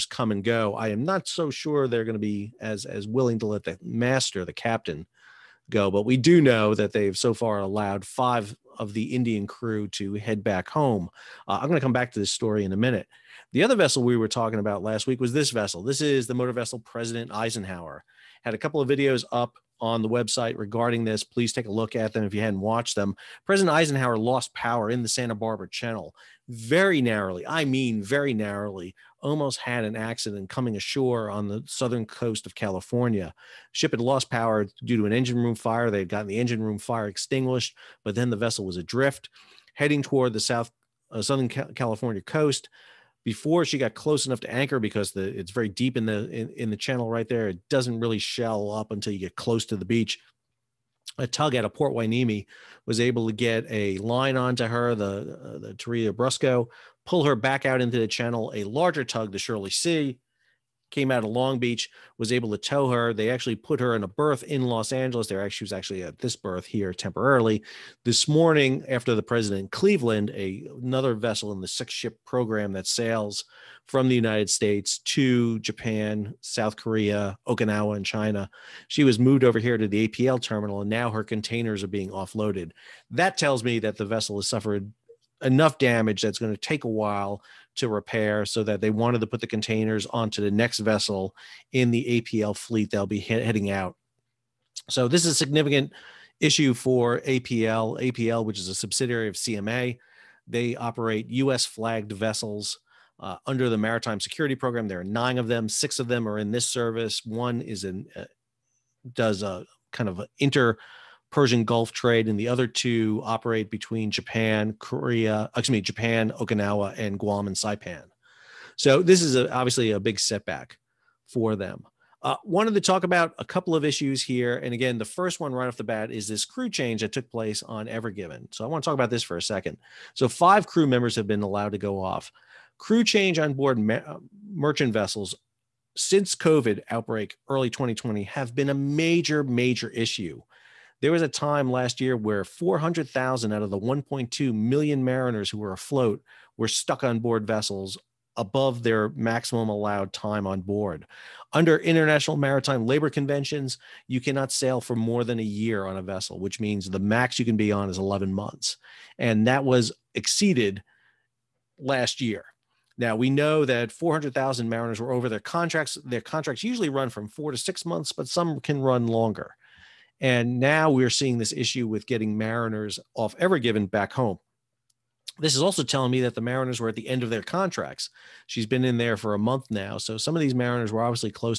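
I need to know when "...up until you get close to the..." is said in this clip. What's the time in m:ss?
0:48.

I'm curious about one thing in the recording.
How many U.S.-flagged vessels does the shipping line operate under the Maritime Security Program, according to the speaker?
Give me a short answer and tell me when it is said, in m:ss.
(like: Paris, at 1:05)
9, at 1:45.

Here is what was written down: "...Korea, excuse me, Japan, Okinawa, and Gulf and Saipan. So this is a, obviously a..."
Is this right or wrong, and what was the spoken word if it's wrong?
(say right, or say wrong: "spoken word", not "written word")
wrong: "Guam", not "Gulf".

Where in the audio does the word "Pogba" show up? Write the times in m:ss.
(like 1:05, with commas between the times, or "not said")
not said.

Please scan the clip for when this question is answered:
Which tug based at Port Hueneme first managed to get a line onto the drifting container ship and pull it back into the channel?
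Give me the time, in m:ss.
0:55.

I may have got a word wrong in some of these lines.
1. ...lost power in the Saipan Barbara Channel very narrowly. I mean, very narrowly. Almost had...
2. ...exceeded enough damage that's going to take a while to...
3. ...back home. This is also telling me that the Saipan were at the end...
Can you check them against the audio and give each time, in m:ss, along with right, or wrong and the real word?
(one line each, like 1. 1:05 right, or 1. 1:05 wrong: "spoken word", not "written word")
1. 0:24 wrong: "Santa", not "Saipan"
2. 1:24 wrong: "suffered", not "exceeded"
3. 2:53 wrong: "Mariners", not "Saipan".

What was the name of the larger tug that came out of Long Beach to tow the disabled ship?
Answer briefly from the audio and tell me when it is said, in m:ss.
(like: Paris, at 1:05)
Shirley Sea, at 0:59.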